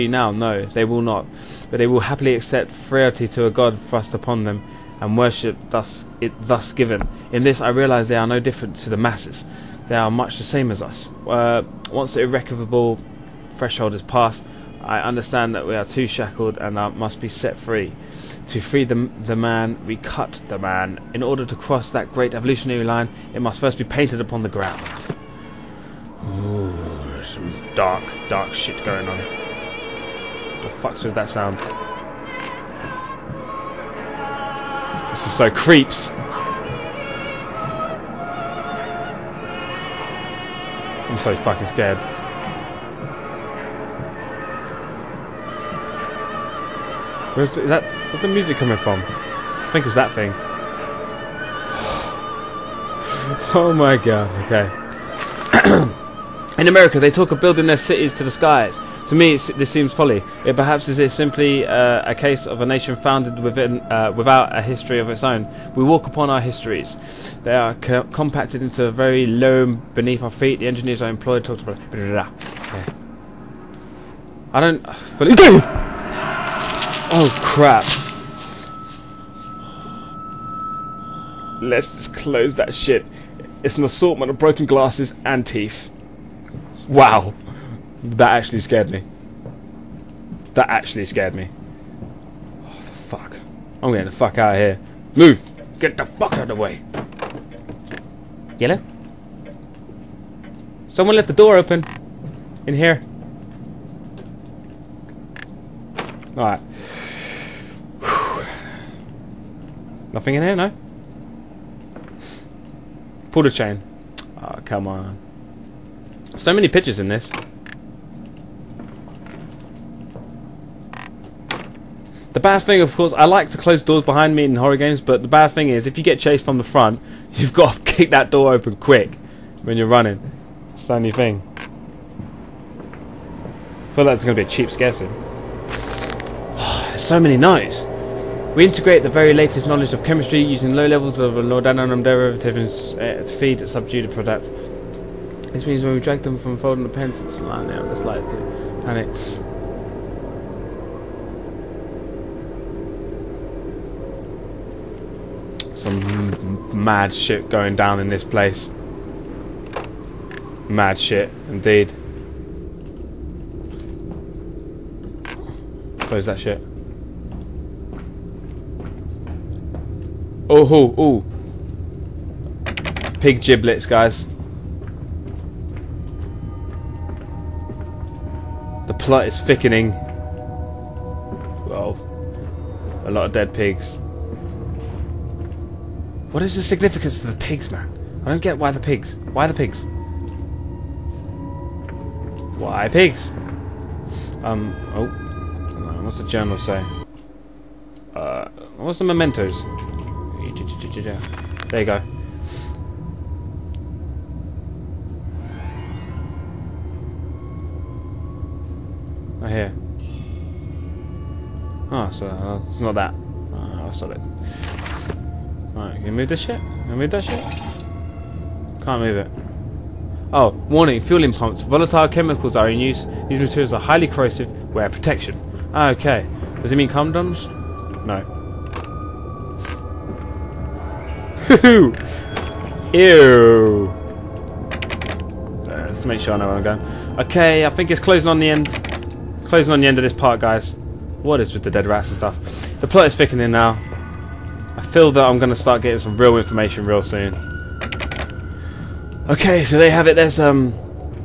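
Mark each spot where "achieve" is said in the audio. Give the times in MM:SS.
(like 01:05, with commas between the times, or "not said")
not said.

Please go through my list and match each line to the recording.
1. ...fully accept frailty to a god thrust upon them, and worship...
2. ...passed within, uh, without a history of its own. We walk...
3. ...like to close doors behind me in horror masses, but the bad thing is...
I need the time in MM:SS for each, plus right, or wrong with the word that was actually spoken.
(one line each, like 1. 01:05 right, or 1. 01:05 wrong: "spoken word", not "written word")
1. 00:01 wrong: "happily", not "fully"
2. 01:02 wrong: "founded", not "passed"
3. 02:03 wrong: "games", not "masses".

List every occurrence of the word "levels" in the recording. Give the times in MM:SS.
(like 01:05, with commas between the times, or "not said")
02:20.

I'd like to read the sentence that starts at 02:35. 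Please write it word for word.
some mad shit going down in this place.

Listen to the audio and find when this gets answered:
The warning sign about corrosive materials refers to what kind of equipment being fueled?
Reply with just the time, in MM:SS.
03:40.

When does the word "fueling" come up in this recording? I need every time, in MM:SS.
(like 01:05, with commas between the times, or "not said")
03:40.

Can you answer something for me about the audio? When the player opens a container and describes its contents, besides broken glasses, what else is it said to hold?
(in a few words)
Teeth.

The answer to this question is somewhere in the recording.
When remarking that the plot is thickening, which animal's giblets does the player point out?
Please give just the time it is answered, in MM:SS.
02:53.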